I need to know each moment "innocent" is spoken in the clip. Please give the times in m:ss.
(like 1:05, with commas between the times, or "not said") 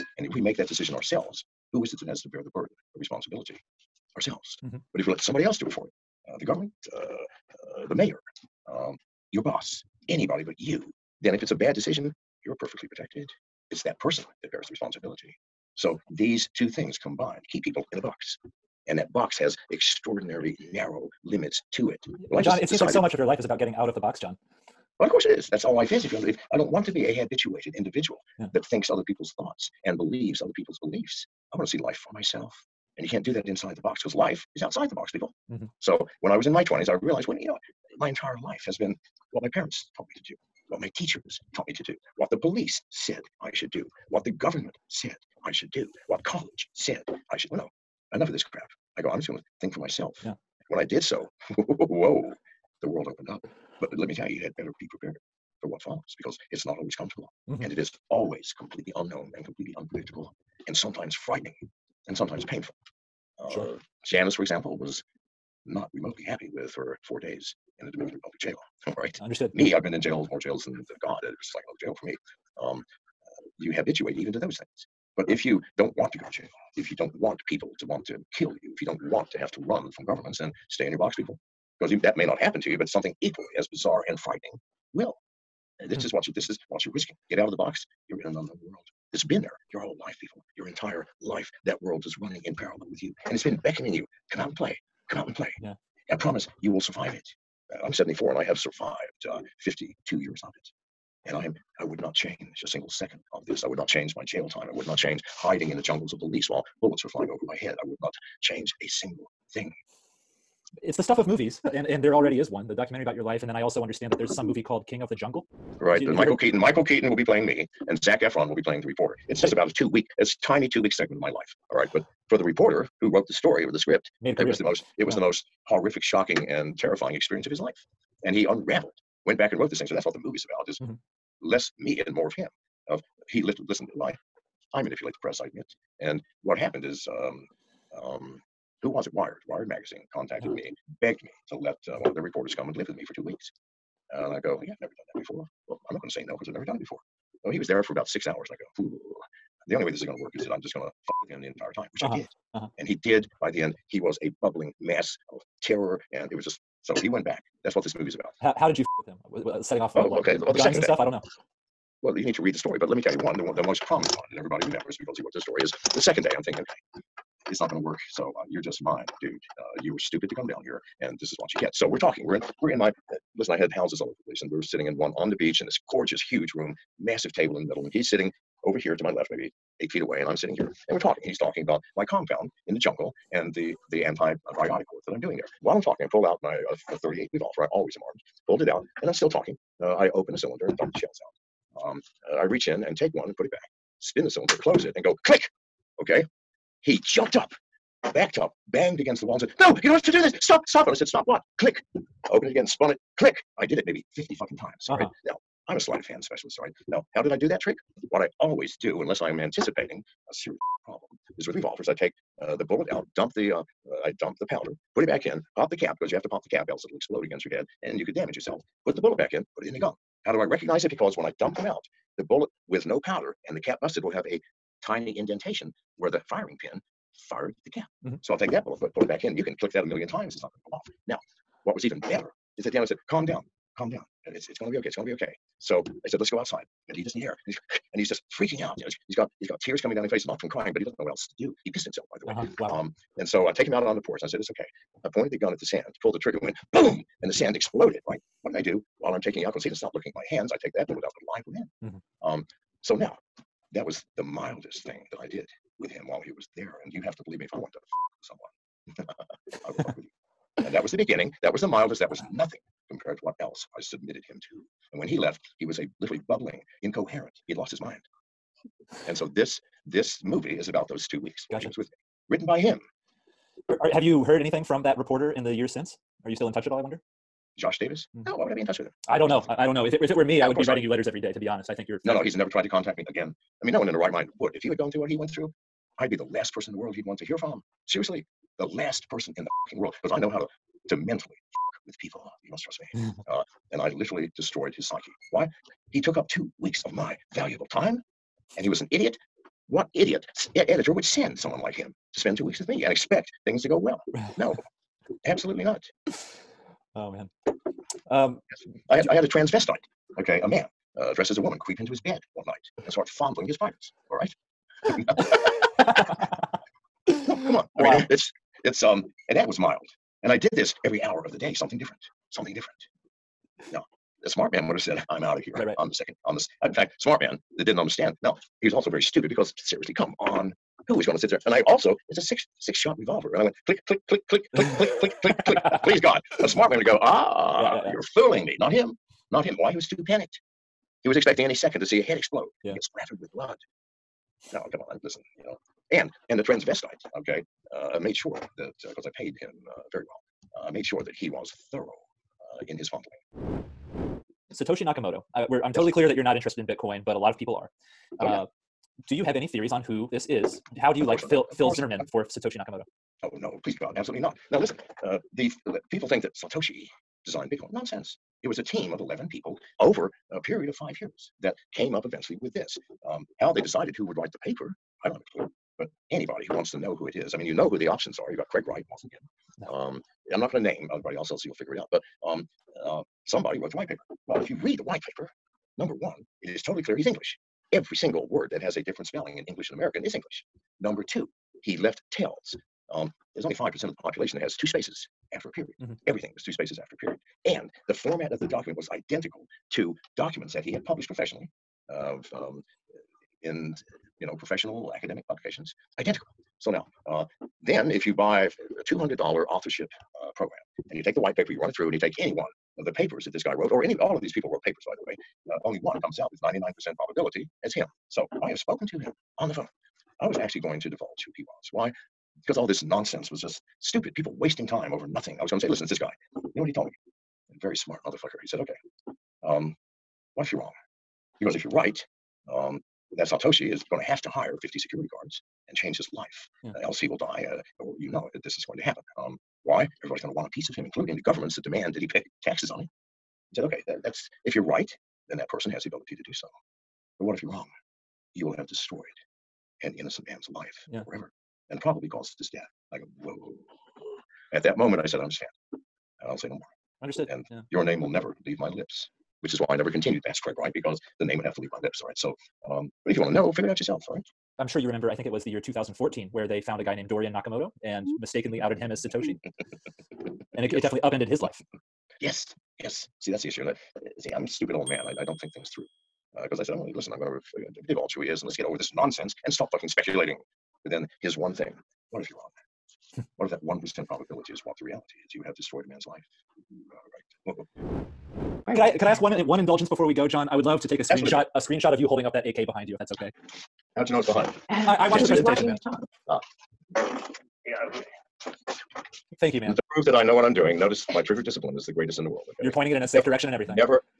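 7:29.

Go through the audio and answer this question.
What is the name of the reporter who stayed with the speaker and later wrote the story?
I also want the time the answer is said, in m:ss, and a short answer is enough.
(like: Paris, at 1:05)
Josh Davis, at 4:37.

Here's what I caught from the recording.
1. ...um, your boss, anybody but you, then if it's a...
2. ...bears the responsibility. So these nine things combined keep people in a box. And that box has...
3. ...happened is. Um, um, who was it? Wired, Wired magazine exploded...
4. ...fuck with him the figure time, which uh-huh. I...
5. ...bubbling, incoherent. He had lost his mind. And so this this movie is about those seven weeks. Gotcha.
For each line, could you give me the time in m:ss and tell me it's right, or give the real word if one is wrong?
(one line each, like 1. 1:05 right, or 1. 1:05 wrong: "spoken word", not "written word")
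1. 0:08 right
2. 0:14 wrong: "two", not "nine"
3. 2:16 wrong: "contacted", not "exploded"
4. 2:30 wrong: "entire", not "figure"
5. 4:26 wrong: "two", not "seven".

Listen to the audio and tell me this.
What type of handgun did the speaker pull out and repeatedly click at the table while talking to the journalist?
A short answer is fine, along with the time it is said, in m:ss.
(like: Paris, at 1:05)
.38 revolver, at 3:06.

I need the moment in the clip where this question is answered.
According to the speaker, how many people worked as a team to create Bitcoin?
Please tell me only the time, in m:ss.
6:08.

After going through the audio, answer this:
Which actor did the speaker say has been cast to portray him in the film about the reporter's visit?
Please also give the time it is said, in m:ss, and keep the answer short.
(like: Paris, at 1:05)
Michael Keaton, at 1:56.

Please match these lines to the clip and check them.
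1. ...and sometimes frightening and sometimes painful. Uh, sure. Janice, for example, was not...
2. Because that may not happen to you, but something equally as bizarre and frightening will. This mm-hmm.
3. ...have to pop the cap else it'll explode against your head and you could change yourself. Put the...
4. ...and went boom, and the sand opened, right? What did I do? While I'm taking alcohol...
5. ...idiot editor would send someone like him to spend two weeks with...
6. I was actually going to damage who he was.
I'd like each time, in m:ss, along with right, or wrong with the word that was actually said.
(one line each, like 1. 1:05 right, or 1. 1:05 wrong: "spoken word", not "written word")
1. 1:00 right
2. 1:21 right
3. 3:36 wrong: "damage", not "change"
4. 4:06 wrong: "exploded", not "opened"
5. 4:59 right
6. 7:00 wrong: "divulge", not "damage".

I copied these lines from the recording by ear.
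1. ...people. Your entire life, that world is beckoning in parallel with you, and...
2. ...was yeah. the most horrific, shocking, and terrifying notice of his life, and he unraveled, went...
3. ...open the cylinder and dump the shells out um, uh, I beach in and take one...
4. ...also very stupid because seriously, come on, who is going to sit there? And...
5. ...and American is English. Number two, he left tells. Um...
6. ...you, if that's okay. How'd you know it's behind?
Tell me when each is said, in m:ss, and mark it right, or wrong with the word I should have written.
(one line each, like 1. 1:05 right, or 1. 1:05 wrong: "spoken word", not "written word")
1. 1:30 wrong: "running", not "beckoning"
2. 2:05 wrong: "experience", not "notice"
3. 3:10 wrong: "reach", not "beach"
4. 5:28 right
5. 6:29 right
6. 8:12 right.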